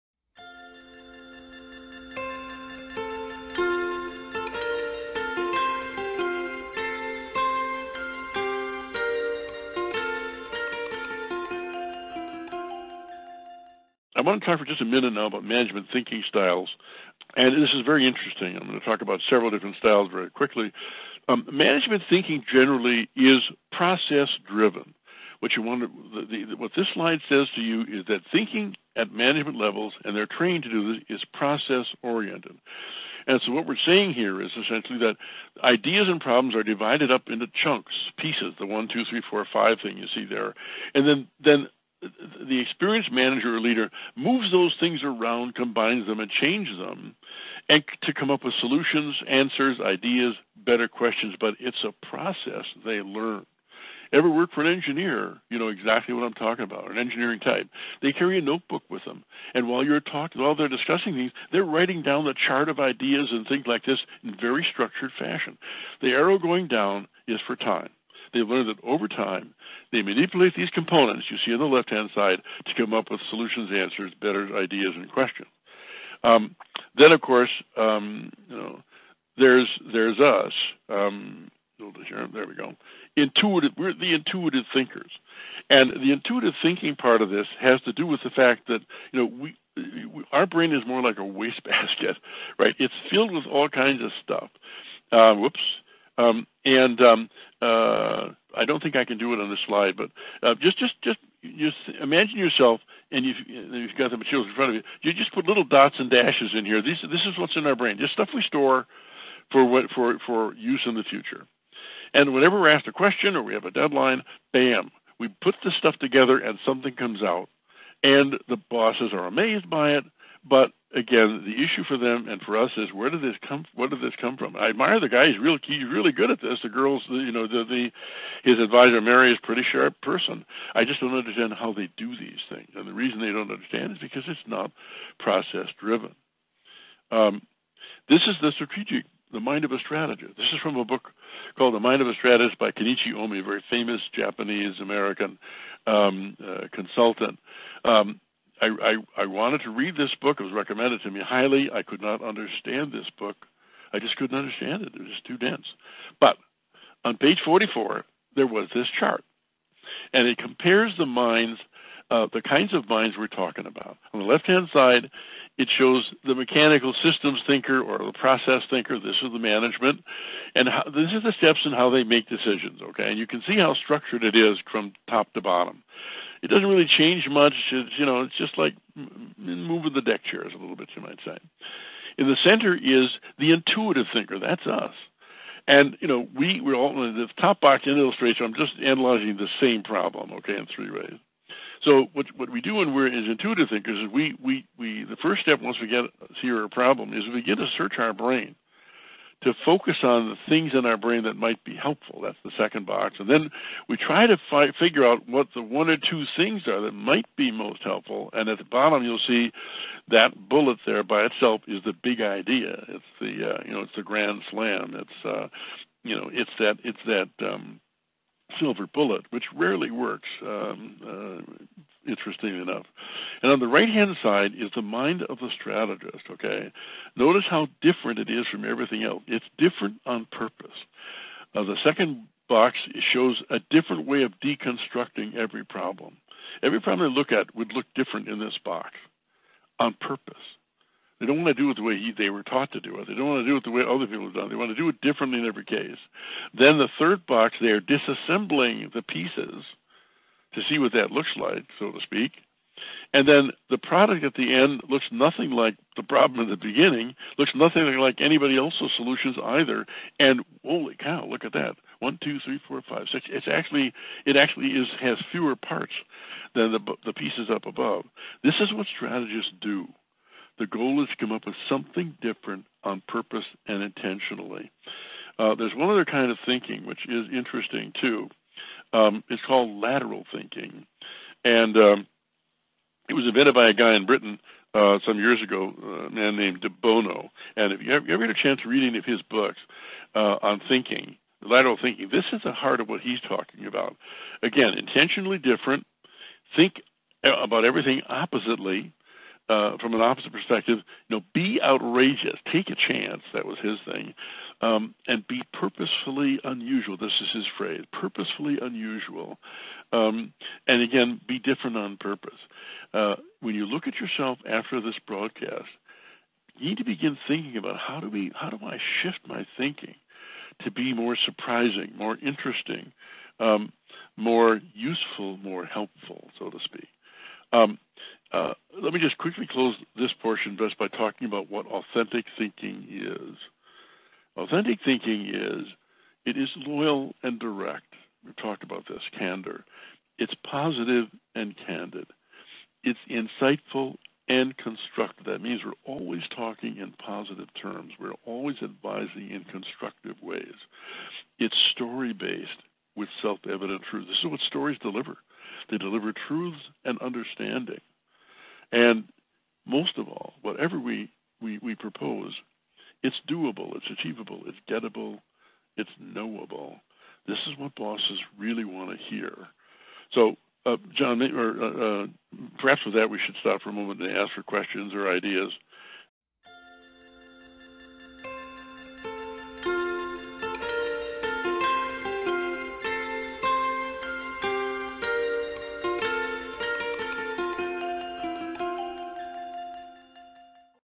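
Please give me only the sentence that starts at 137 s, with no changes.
Um, this is the strategic, the mind of a strategist.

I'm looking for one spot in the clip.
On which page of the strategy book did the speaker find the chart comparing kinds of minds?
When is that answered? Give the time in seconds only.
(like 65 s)
157 s.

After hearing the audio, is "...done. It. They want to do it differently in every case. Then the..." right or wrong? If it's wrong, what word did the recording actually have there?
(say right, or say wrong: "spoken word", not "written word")
right.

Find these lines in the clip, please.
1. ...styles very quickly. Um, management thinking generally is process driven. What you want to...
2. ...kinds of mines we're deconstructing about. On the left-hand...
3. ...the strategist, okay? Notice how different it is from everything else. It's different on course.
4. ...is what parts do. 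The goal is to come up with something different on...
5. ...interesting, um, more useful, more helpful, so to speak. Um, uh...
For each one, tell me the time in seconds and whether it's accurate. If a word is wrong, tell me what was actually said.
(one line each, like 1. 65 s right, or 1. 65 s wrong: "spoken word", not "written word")
1. 19 s right
2. 162 s wrong: "talking", not "deconstructing"
3. 225 s wrong: "purpose", not "course"
4. 268 s wrong: "strategists", not "parts"
5. 322 s right.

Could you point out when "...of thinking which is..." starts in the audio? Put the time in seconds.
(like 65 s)
276 s.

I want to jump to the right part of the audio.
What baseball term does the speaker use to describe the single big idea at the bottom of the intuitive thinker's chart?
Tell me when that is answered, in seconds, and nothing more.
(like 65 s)
214 s.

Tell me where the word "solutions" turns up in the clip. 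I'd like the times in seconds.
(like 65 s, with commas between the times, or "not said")
48 s, 73 s, 258 s.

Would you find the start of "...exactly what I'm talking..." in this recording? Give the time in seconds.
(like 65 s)
55 s.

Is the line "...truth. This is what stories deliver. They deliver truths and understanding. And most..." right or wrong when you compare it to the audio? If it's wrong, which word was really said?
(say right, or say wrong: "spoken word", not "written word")
right.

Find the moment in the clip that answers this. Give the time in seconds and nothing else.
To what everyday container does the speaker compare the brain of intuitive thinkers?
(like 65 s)
91 s.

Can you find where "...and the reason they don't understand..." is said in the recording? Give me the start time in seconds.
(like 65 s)
132 s.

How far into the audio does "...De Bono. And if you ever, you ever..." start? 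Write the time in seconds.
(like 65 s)
286 s.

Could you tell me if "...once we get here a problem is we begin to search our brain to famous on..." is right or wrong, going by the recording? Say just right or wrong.
wrong.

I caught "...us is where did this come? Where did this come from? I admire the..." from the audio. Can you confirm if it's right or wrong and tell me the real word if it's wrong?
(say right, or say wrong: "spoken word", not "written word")
right.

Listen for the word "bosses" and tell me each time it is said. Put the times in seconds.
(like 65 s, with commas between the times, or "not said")
118 s, 367 s.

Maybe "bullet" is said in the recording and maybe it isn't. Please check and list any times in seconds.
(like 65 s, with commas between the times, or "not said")
210 s, 218 s.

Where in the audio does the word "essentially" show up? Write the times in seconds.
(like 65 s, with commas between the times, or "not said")
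34 s.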